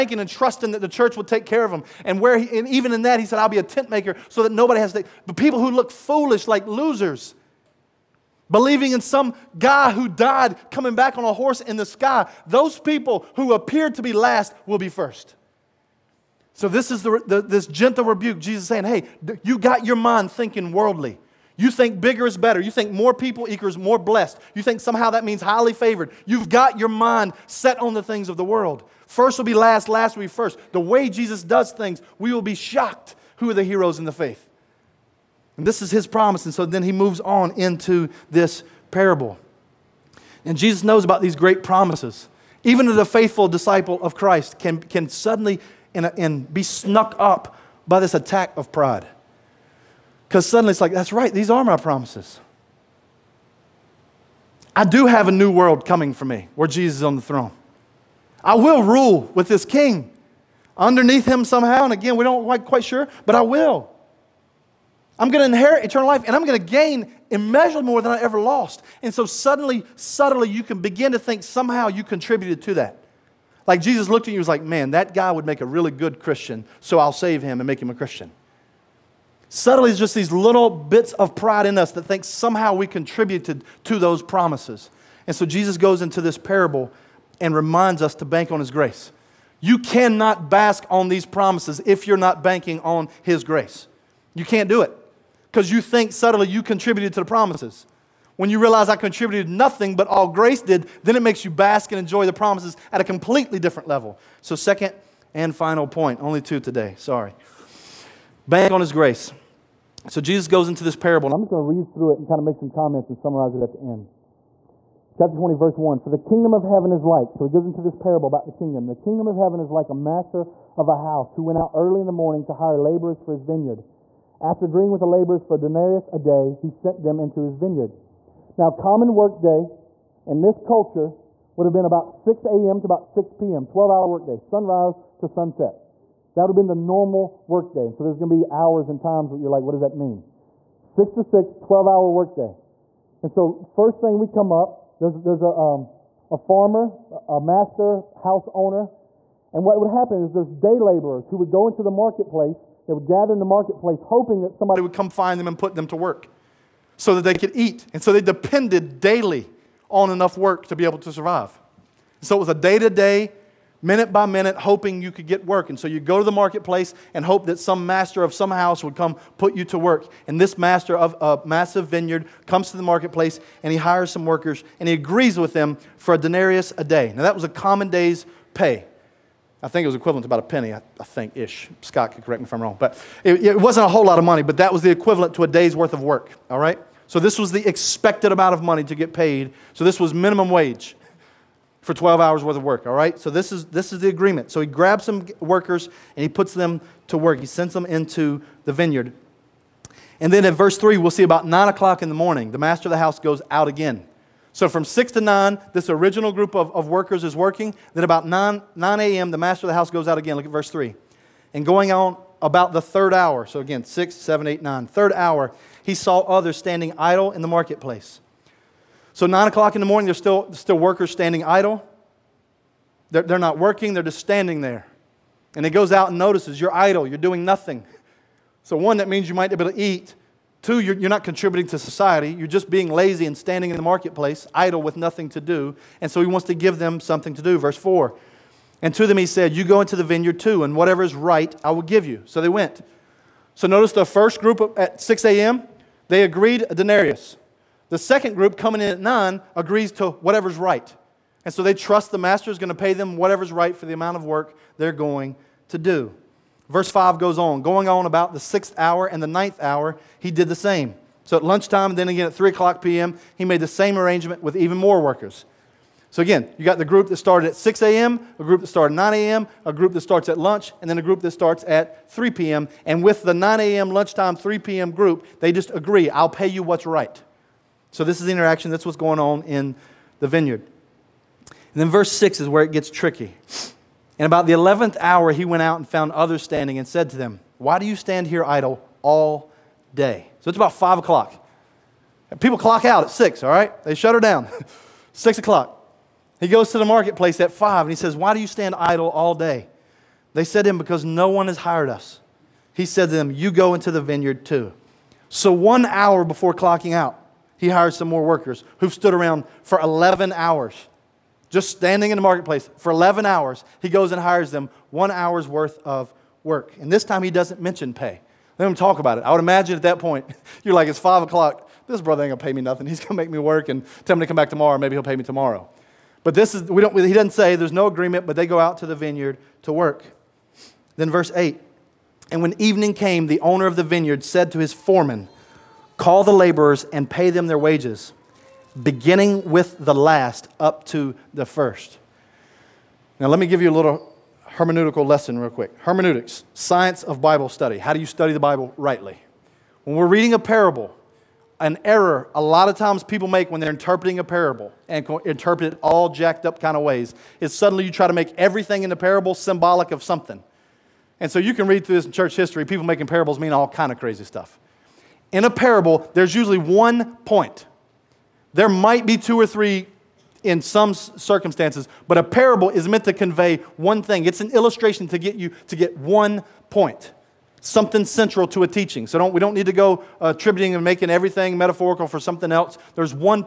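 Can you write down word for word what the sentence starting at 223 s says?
They're, they're not working, they're just standing there.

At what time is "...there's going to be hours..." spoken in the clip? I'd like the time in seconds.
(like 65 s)
138 s.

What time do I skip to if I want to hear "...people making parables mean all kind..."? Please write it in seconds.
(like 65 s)
362 s.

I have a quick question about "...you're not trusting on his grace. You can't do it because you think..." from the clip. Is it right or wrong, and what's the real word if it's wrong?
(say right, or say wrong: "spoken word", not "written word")
wrong: "banking", not "trusting".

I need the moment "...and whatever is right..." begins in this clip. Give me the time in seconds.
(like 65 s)
240 s.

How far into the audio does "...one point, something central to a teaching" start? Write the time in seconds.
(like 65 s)
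375 s.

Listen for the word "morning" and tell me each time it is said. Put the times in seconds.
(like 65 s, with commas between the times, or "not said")
122 s, 202 s, 219 s.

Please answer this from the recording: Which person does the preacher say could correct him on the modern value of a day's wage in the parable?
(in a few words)
Scott.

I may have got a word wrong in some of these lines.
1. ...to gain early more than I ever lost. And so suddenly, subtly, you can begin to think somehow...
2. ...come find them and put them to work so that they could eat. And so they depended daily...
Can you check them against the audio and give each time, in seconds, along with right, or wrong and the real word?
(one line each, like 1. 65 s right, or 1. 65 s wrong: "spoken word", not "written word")
1. 66 s wrong: "immeasurably", not "early"
2. 154 s right.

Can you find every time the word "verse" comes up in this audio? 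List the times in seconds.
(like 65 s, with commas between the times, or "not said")
115 s, 200 s, 210 s, 237 s, 256 s, 281 s, 331 s.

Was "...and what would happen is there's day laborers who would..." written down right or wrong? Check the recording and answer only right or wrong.
right.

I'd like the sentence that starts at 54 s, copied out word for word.
I do have a new world coming for me where Jesus is on the throne.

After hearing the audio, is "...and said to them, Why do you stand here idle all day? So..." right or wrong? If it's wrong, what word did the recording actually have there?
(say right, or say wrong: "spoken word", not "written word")
right.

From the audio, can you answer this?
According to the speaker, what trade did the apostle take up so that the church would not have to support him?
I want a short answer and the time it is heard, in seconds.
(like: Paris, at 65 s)
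Tent maker, at 3 s.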